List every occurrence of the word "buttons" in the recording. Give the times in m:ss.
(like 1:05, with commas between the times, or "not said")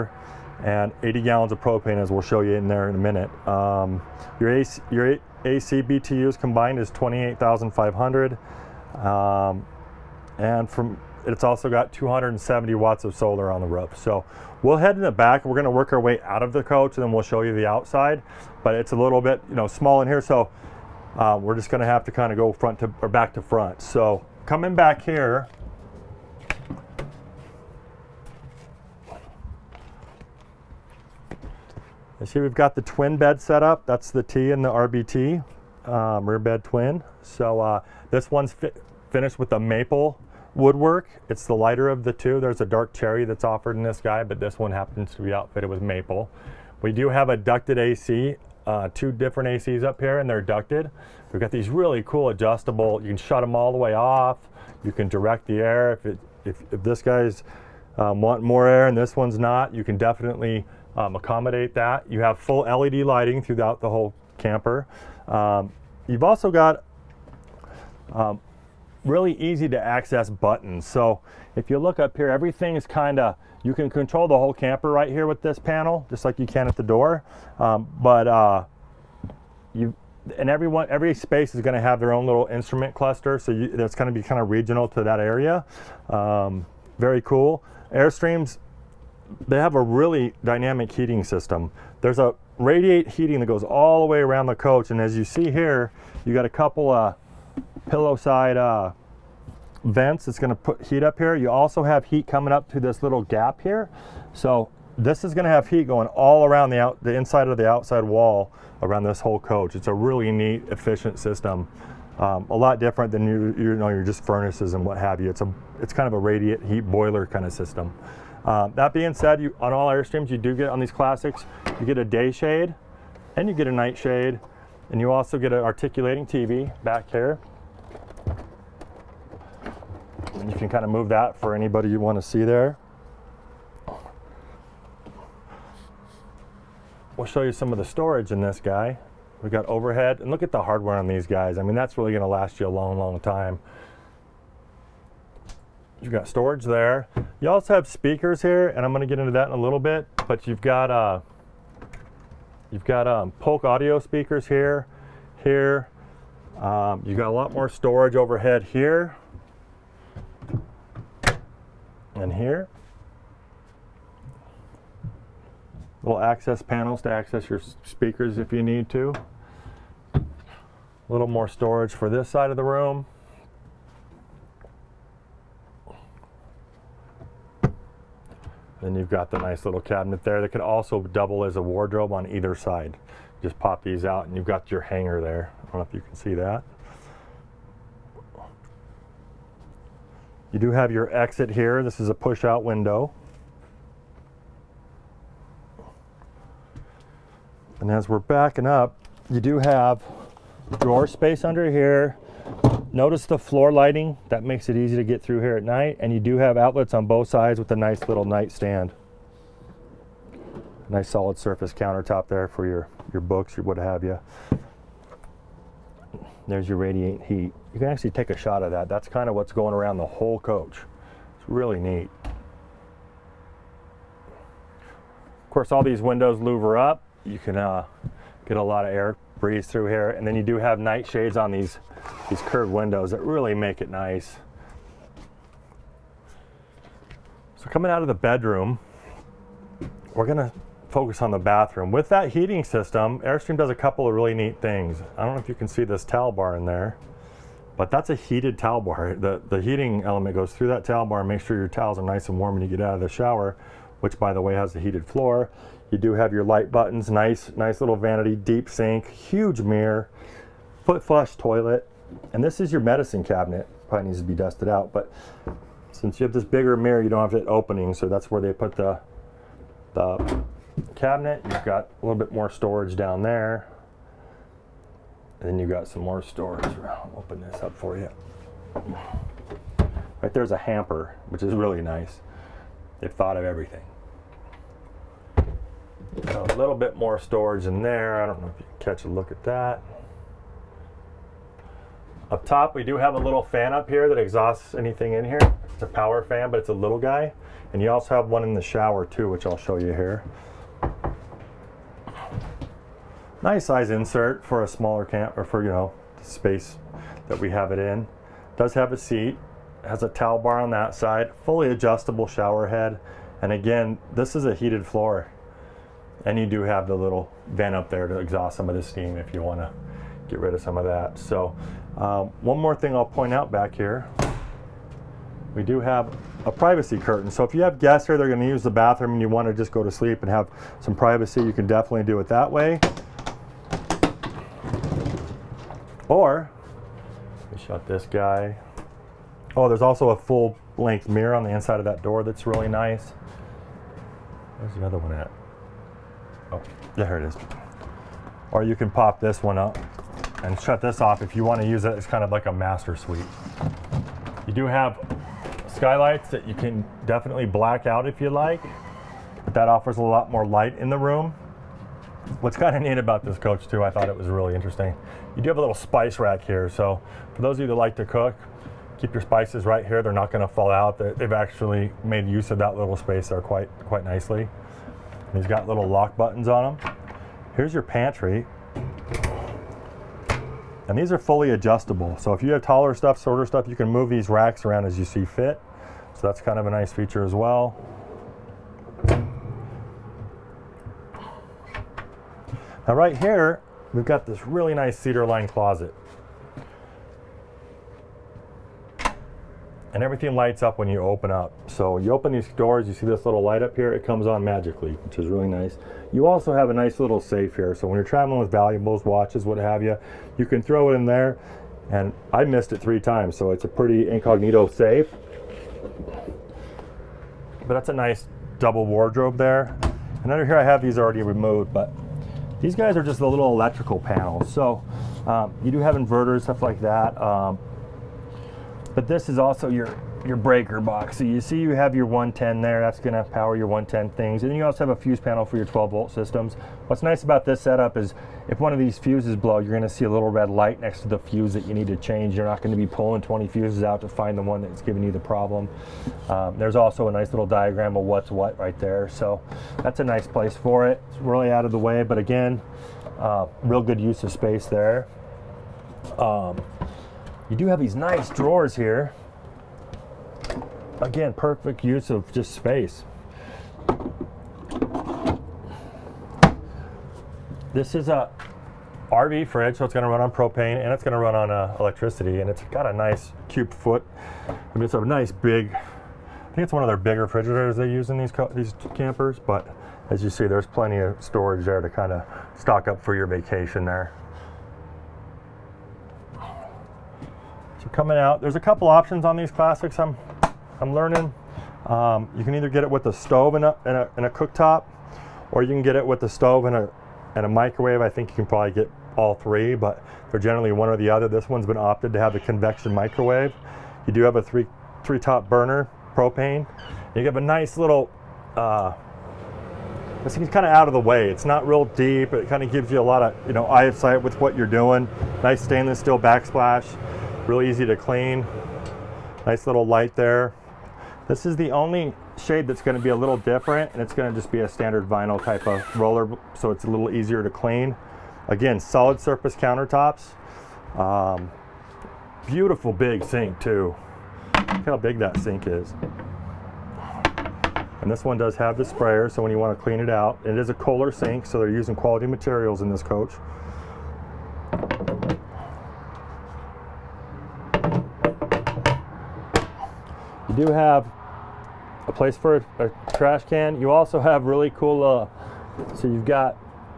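1:10, 4:16, 6:16.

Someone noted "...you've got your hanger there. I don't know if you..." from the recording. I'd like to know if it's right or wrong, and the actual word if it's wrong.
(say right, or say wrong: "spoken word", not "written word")
right.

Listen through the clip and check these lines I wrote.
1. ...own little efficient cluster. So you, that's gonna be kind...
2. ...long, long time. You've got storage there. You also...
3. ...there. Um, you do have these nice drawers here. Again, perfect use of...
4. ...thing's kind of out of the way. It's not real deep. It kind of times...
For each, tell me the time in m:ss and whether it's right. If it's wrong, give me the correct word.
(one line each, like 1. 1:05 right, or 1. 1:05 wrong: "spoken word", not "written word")
1. 1:22 wrong: "instrument", not "efficient"
2. 2:22 right
3. 7:34 right
4. 8:30 wrong: "gives", not "times".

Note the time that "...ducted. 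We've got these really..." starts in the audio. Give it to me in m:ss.
0:50.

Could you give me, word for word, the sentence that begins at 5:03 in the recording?
Nice size insert for a smaller camp or for, you know, the space that we have it in.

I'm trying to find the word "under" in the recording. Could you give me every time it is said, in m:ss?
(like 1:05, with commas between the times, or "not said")
3:21, 7:00.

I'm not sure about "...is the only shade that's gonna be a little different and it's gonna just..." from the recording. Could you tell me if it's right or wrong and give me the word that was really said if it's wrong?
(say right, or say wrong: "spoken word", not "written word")
right.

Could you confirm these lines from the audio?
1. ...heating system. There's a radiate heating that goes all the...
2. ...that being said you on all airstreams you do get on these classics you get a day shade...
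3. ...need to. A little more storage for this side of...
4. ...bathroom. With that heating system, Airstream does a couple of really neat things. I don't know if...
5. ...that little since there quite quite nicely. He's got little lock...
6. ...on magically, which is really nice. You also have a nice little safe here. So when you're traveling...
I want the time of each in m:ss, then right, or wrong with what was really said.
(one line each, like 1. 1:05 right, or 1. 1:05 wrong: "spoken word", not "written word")
1. 1:30 right
2. 1:58 right
3. 2:48 right
4. 4:01 right
5. 6:12 wrong: "space", not "since"
6. 6:44 right.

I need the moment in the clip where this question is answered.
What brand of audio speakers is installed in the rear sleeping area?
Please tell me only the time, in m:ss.
2:33.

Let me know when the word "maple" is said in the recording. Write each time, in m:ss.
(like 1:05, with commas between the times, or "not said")
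0:39, 0:45.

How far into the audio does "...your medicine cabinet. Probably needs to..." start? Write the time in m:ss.
4:22.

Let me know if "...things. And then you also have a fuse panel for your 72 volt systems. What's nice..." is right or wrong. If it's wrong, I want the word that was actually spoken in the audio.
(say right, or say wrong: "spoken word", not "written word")
wrong: "12", not "72".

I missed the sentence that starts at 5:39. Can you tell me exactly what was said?
Oh, there's also a full length mirror on the inside of that door that's really nice.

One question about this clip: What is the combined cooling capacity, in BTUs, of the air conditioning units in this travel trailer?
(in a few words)
28,500.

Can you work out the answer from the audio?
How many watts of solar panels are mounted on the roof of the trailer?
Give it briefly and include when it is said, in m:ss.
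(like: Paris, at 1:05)
270, at 0:11.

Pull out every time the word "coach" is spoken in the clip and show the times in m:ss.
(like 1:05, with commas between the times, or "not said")
0:16, 1:34, 1:49, 3:40, 6:03, 9:03.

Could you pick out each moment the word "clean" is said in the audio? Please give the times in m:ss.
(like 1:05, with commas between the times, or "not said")
8:37, 8:47, 8:59.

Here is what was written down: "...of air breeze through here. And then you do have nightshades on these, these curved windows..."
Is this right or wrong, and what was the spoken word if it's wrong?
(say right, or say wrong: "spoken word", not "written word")
right.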